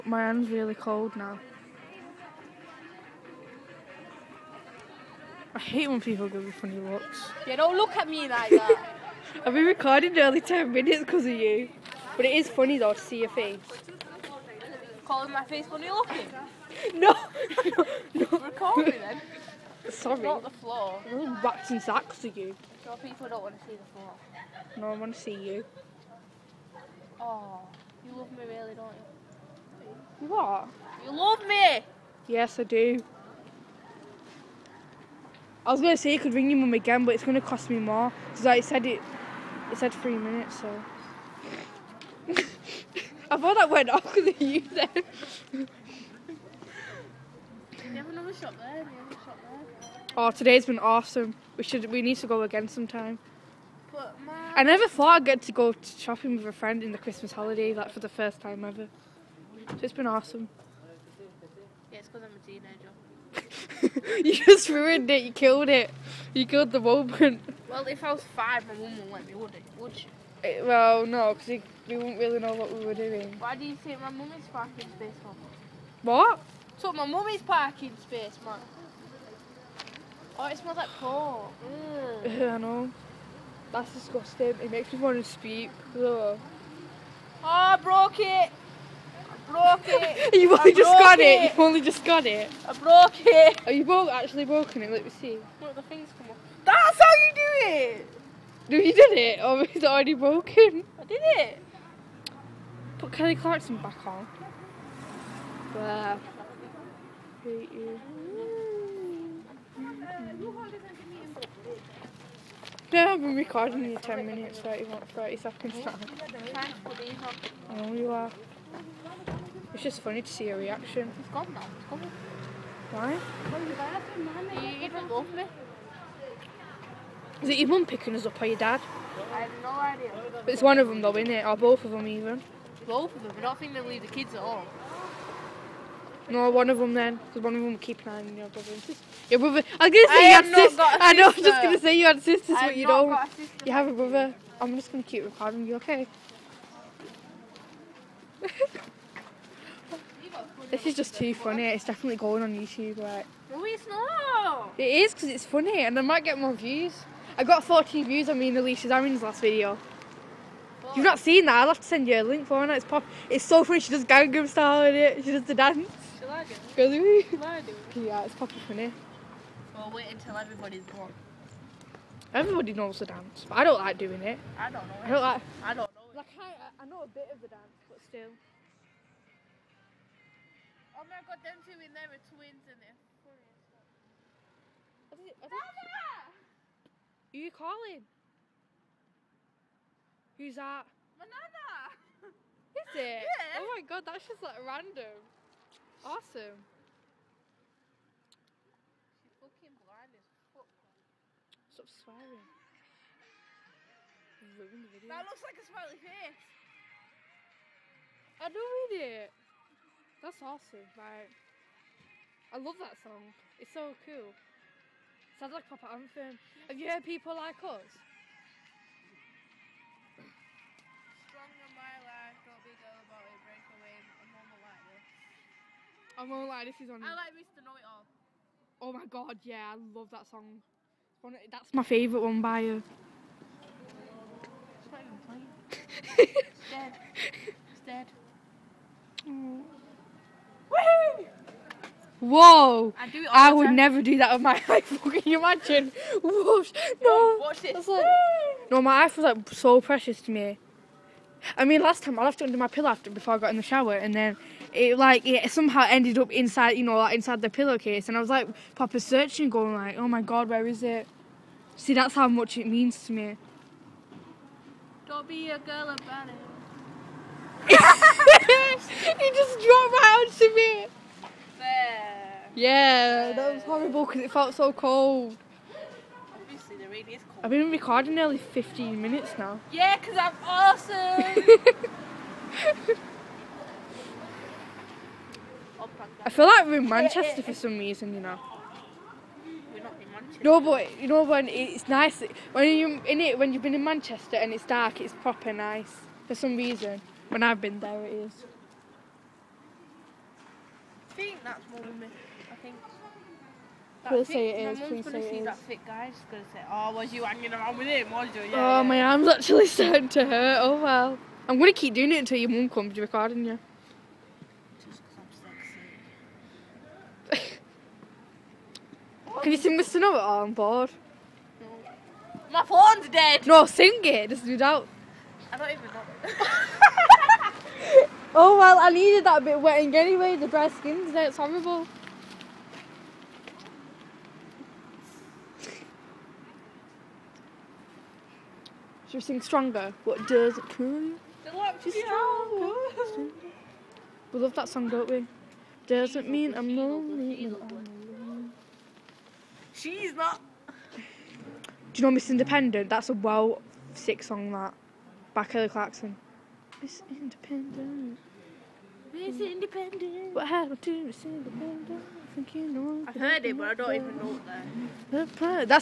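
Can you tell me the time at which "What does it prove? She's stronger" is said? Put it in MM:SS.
05:40.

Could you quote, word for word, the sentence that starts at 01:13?
Why do you think my mummy's parking space Mum?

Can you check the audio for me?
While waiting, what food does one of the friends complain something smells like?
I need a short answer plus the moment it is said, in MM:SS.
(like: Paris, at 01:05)
Pork, at 01:20.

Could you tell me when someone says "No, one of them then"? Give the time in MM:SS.
02:16.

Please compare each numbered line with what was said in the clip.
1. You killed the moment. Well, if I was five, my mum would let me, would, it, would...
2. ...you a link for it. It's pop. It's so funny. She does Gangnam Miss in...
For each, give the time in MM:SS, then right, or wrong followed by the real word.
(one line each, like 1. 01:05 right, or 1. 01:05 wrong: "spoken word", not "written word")
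1. 01:06 right
2. 02:42 wrong: "Style", not "Miss".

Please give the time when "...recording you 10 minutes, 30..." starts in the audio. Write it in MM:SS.
01:53.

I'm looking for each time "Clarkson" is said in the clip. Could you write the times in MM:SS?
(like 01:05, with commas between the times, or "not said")
01:43, 05:55.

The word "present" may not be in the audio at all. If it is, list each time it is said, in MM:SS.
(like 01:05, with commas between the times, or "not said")
not said.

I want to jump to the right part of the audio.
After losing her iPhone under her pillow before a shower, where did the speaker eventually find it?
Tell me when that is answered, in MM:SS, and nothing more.
04:17.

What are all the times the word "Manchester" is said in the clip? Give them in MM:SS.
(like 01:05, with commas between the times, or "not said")
04:46, 04:53.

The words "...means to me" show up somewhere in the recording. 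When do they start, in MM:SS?
04:22.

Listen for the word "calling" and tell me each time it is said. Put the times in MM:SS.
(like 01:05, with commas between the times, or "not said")
00:15, 03:07.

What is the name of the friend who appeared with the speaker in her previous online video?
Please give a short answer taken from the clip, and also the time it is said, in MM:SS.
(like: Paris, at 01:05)
Alicia Zarin, at 02:38.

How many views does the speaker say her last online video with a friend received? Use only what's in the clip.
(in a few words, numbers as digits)
14.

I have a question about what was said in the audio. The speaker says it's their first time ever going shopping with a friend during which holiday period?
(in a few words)
Christmas holiday.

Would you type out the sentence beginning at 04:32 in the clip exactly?
Yeah, that was horrible because it felt so cold.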